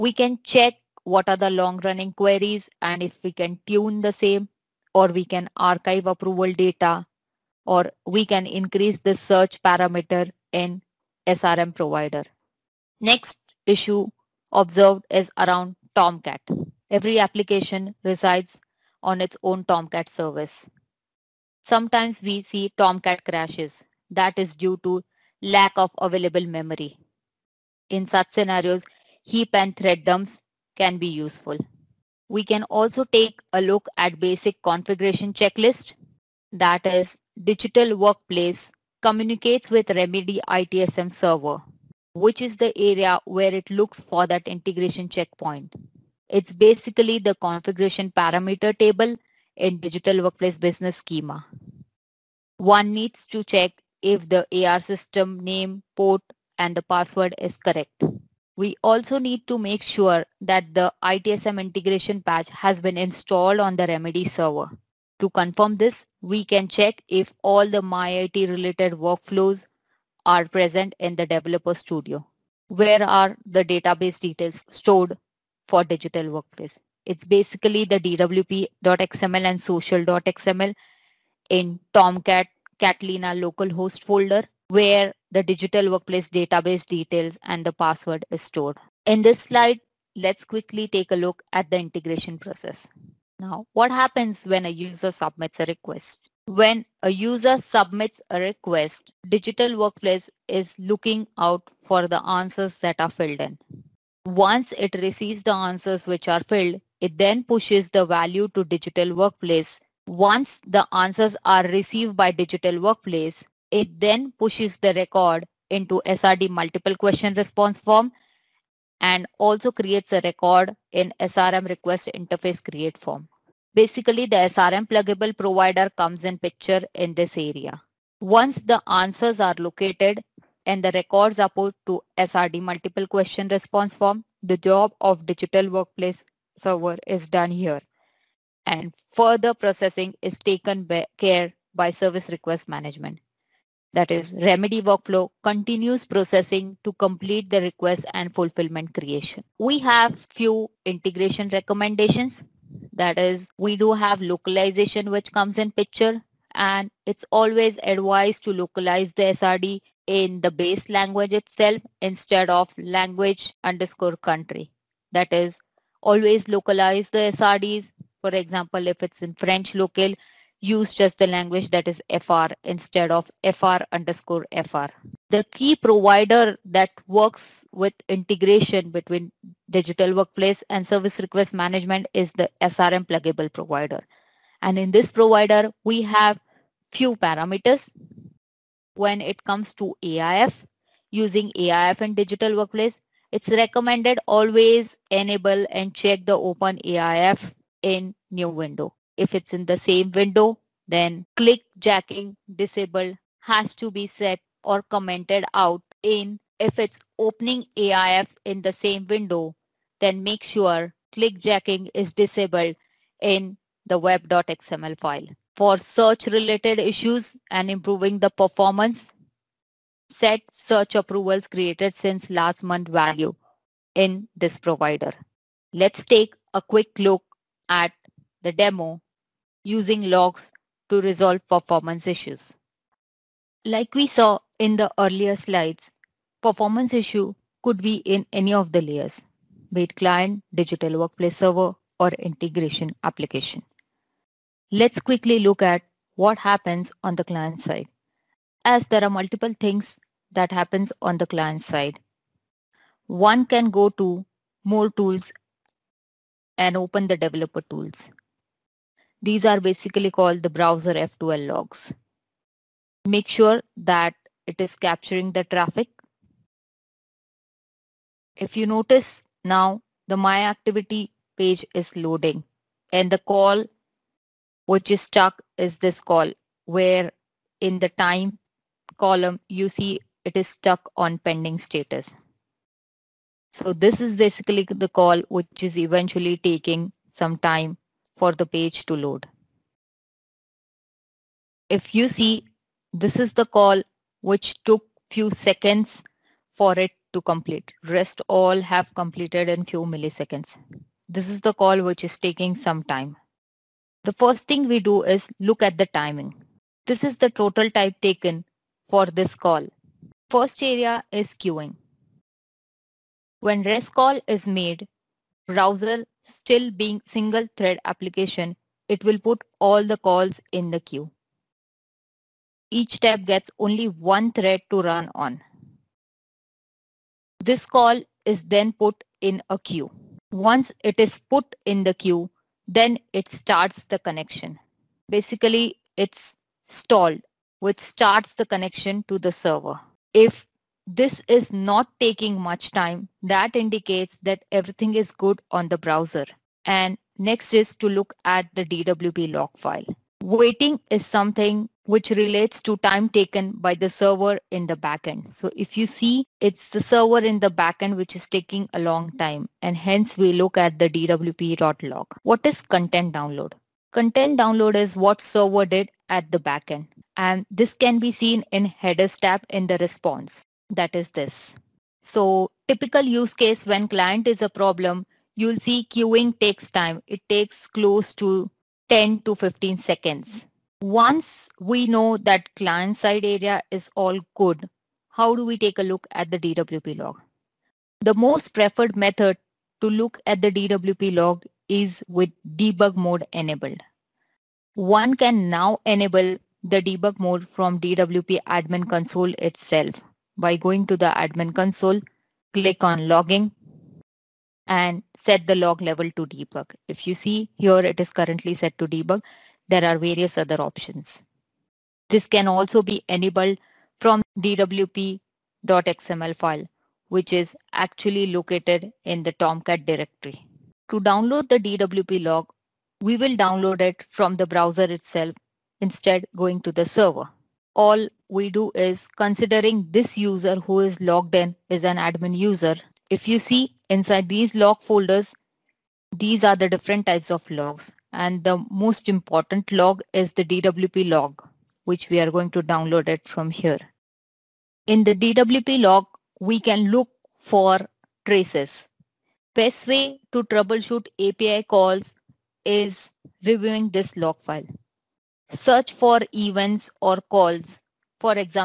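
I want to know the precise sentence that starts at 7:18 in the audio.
And the most important log is the DWP log, which we are going to download it from here.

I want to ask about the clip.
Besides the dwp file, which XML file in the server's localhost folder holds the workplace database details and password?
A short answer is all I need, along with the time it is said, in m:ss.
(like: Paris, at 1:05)
social.xml, at 1:19.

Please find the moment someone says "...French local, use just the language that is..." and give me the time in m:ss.
2:49.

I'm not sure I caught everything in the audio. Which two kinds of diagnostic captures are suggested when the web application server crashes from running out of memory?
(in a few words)
heap and thread dumps.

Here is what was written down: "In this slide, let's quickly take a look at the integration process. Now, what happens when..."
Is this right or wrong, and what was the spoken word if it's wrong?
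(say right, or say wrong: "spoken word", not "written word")
right.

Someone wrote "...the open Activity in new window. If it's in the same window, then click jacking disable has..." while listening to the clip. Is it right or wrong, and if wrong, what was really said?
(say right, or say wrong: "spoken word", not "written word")
wrong: "AIF", not "Activity".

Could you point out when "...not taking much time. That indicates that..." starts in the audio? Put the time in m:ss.
5:41.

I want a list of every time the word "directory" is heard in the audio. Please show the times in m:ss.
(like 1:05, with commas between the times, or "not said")
6:59.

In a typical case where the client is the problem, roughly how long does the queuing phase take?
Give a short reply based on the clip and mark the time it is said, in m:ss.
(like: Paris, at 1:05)
10 to 15 seconds, at 6:18.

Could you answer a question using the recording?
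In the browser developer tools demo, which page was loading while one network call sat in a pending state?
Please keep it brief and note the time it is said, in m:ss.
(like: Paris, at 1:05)
My Activity, at 4:30.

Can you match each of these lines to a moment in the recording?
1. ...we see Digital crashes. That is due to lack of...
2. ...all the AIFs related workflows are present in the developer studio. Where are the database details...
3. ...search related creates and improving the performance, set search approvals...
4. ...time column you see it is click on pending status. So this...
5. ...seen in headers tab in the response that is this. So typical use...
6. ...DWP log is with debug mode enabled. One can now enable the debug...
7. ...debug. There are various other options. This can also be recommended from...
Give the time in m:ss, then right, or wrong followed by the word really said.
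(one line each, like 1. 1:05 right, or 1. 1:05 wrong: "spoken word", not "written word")
1. 0:22 wrong: "Tomcat", not "Digital"
2. 1:07 wrong: "MyIT", not "AIFs"
3. 3:35 wrong: "issues", not "creates"
4. 4:37 wrong: "stuck", not "click"
5. 6:08 right
6. 6:30 right
7. 6:48 wrong: "enabled", not "recommended".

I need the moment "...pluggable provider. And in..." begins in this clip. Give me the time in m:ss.
3:03.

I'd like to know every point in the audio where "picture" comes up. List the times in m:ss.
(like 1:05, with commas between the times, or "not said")
2:06, 2:35.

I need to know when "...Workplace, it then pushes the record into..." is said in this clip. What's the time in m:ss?
1:52.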